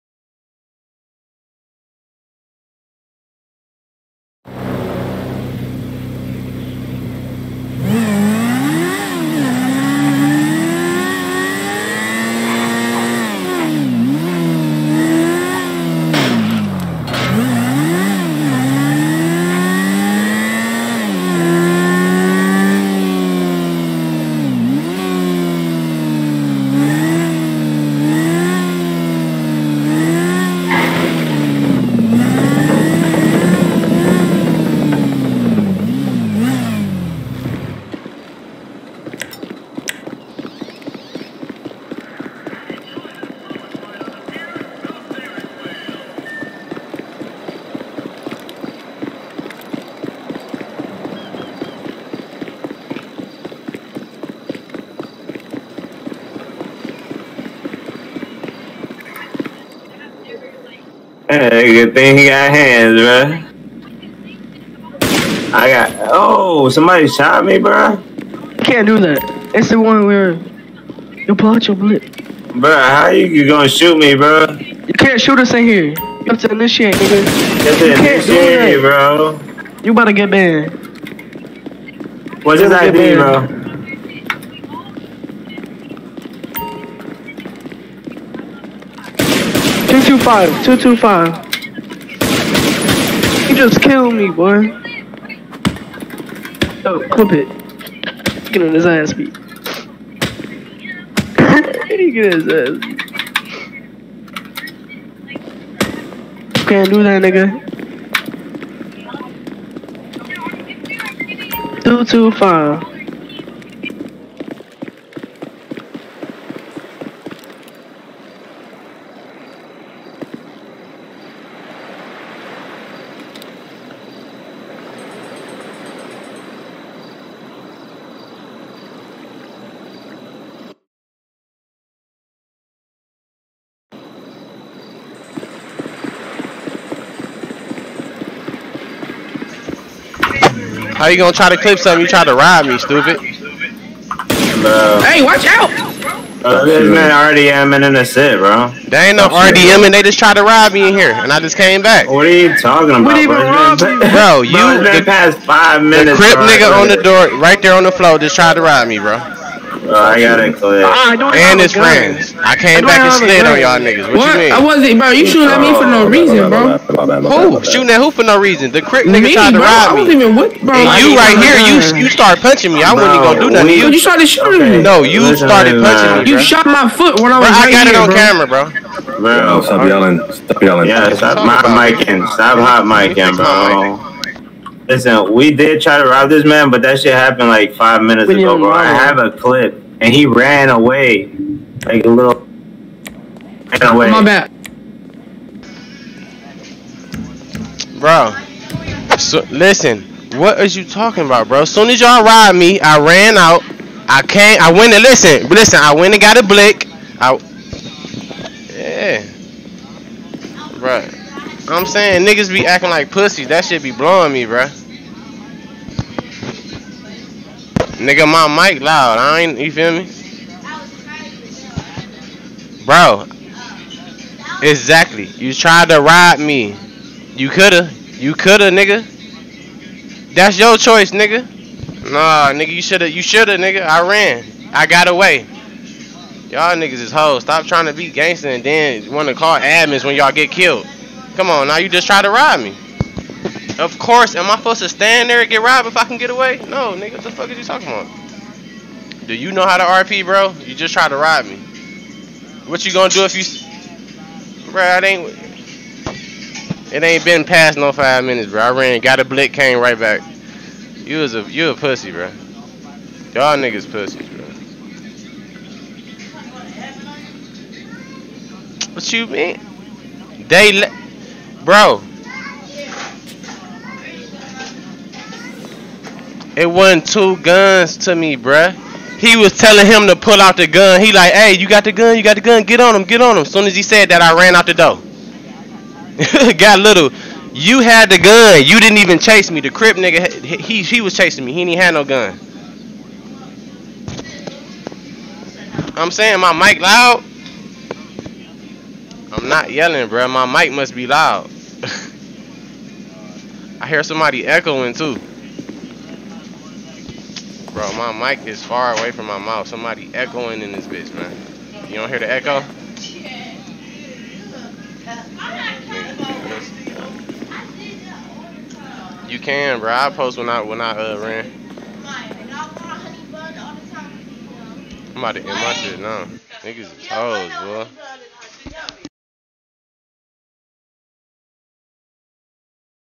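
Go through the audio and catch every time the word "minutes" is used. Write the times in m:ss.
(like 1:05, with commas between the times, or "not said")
2:35, 3:08, 4:18.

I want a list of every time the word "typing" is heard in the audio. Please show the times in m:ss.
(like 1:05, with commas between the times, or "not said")
not said.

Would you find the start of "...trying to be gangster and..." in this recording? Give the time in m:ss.
3:57.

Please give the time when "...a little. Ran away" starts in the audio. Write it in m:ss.
3:12.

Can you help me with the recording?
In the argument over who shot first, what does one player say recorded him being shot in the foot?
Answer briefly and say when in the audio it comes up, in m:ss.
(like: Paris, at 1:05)
camera, at 2:58.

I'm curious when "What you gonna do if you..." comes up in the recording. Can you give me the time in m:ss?
4:12.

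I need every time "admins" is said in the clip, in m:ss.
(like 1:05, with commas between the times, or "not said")
3:59.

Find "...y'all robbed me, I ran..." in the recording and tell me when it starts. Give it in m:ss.
3:22.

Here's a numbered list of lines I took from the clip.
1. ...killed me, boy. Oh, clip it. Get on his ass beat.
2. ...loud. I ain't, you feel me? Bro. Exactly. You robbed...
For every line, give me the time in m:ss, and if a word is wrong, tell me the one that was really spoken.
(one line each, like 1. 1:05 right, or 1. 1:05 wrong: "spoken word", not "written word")
1. 1:33 right
2. 3:38 wrong: "tried", not "robbed".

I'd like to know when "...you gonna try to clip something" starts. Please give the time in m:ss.
2:21.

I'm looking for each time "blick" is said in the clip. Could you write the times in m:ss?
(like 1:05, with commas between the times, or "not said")
3:26, 4:19.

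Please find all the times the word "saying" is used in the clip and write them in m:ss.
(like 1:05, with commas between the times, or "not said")
3:31, 4:56.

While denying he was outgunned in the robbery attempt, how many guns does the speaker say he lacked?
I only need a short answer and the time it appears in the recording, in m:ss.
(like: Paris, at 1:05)
2, at 4:37.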